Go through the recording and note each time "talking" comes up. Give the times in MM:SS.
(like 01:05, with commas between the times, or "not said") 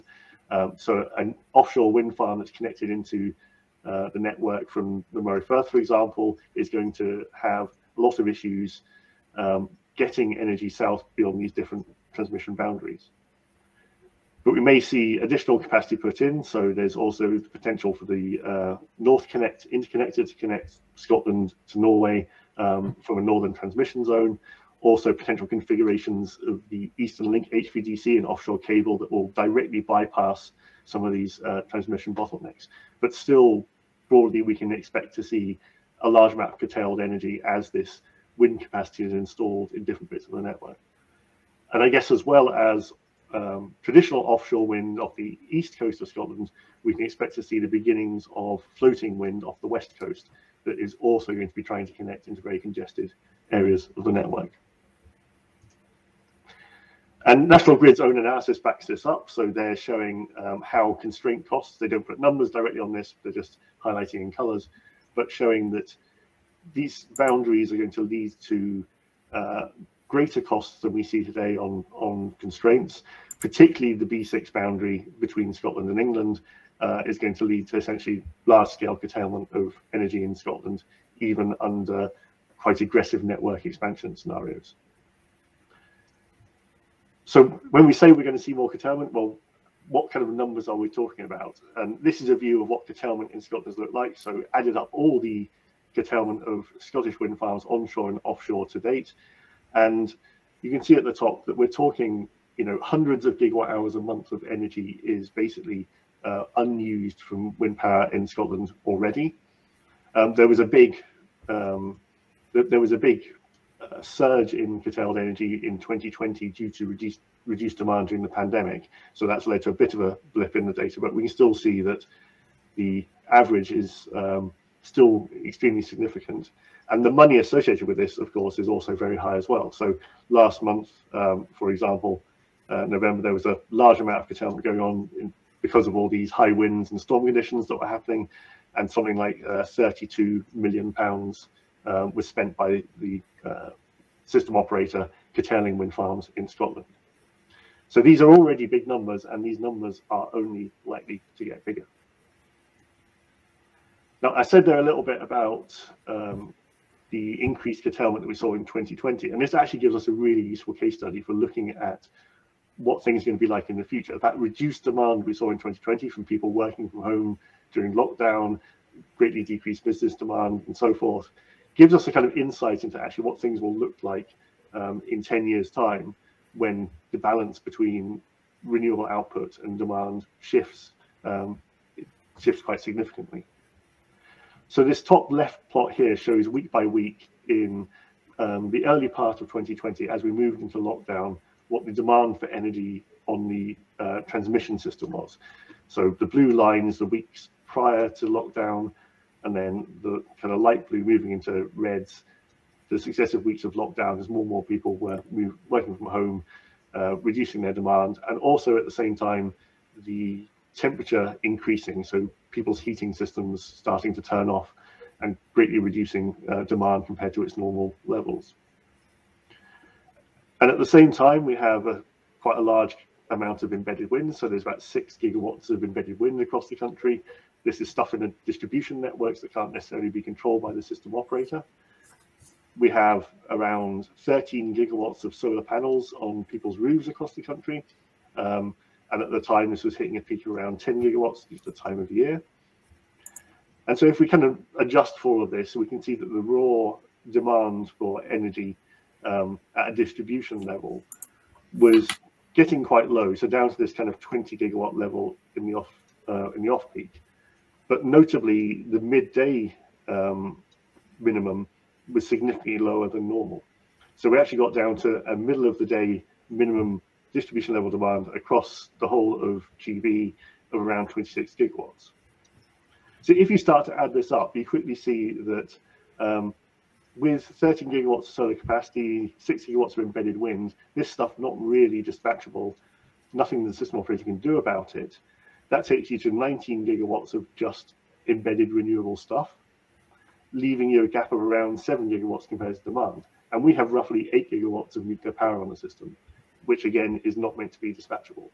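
01:30, 01:41.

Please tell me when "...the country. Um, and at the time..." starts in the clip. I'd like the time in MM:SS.
03:57.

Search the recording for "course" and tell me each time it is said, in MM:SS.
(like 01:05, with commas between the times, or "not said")
02:08.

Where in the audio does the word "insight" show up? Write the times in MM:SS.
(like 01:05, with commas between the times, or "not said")
02:52.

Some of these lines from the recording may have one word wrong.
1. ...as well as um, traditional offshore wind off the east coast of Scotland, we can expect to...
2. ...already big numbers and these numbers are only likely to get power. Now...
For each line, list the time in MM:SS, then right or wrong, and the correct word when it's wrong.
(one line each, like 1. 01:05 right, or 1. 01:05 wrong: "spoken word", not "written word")
1. 00:42 right
2. 02:28 wrong: "bigger", not "power".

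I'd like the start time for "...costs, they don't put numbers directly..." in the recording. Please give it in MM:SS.
01:01.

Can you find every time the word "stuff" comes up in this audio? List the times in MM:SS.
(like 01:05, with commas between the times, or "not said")
03:47, 04:41, 04:49.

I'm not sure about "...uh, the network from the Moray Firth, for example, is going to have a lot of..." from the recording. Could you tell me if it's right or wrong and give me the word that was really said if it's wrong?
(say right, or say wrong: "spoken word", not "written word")
right.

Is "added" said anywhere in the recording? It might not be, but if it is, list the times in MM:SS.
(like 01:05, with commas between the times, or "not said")
01:34.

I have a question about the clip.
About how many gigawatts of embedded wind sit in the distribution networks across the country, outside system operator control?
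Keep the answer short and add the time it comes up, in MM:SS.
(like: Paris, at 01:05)
6 gigawatts, at 03:44.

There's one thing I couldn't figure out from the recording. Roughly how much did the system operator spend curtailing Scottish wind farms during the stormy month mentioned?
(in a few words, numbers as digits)
32 million pounds.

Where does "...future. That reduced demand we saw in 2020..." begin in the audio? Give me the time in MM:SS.
02:43.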